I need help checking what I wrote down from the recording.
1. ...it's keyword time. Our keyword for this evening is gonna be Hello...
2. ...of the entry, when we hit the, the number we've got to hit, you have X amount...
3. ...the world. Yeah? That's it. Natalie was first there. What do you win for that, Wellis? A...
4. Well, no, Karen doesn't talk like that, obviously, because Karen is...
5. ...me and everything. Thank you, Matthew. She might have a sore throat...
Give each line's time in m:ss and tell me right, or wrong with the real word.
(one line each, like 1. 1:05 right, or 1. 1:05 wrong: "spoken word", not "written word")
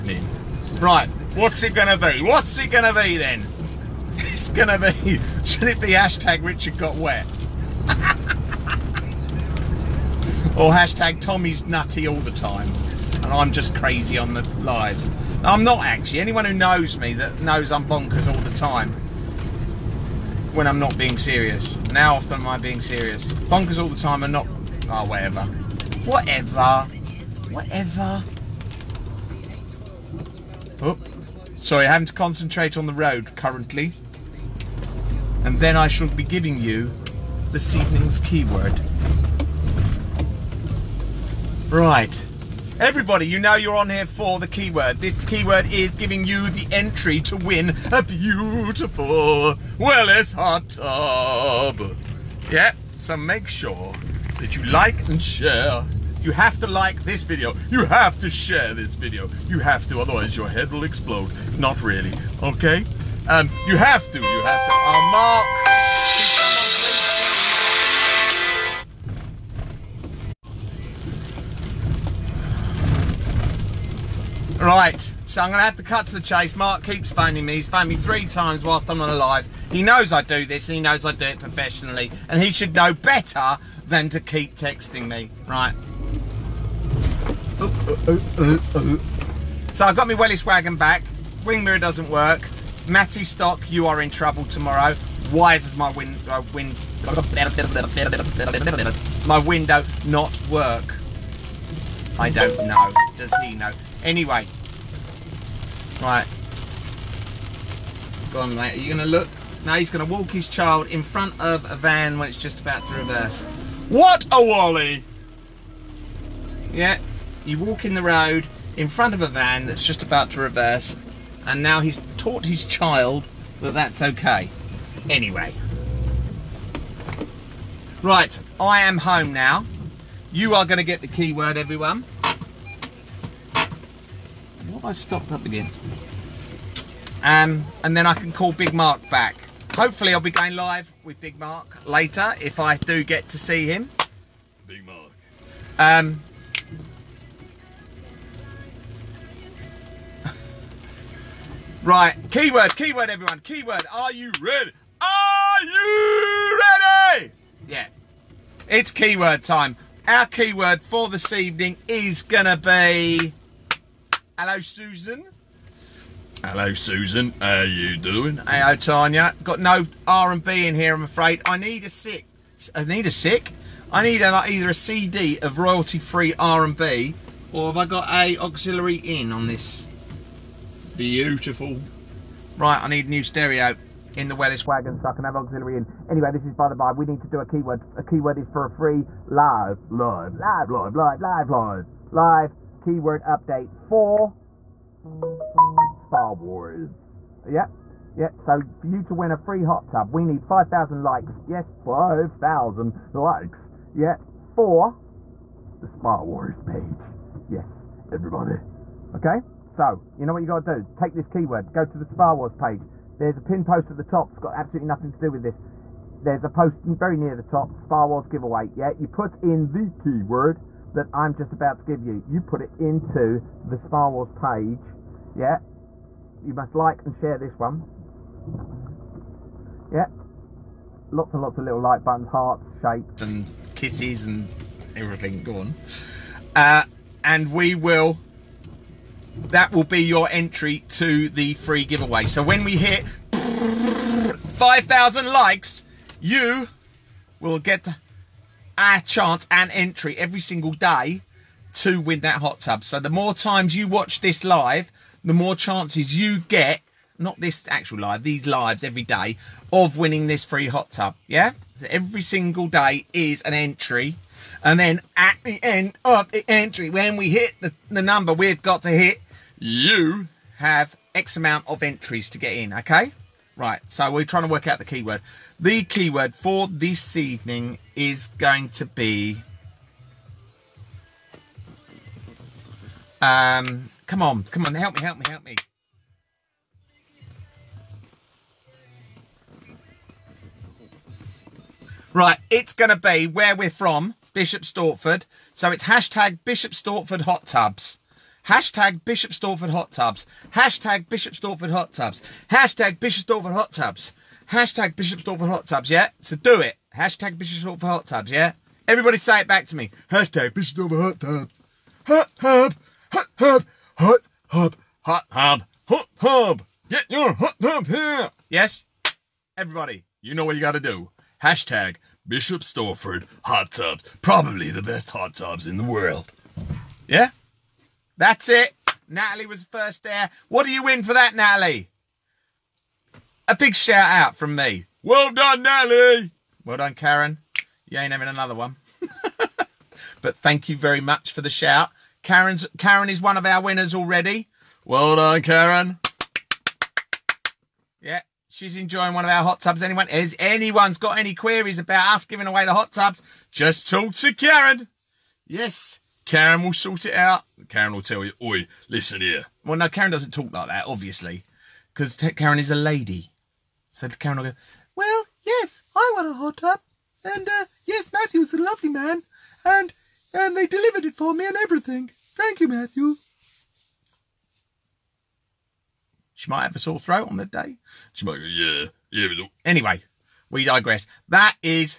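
1. 2:38 right
2. 4:26 right
3. 5:25 wrong: "Natalie", not "Wellis"
4. 5:59 right
5. 6:11 right.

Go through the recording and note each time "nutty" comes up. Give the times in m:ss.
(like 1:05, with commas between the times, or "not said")
0:11.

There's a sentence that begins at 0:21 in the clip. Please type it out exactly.
now often am I being serious?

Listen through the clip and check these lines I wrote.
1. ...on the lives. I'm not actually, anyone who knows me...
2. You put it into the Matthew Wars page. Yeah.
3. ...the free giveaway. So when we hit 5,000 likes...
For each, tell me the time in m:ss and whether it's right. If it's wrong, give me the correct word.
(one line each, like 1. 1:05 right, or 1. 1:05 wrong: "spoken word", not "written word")
1. 0:14 right
2. 3:42 wrong: "Spa", not "Matthew"
3. 4:01 right.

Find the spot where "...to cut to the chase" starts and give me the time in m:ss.
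1:15.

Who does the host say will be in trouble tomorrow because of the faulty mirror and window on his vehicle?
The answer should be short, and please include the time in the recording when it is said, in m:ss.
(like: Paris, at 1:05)
Matty Stock, at 1:32.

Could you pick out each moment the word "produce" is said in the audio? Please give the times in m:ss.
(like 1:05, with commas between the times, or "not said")
not said.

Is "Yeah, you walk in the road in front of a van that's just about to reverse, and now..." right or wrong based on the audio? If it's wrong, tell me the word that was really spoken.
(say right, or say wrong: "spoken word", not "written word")
right.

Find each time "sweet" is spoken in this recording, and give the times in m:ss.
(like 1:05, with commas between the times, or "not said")
not said.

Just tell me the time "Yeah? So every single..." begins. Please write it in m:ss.
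4:21.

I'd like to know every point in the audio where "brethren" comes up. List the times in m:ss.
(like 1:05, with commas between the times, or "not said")
not said.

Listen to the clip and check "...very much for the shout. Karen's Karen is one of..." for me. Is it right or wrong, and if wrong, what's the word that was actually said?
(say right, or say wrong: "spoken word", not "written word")
right.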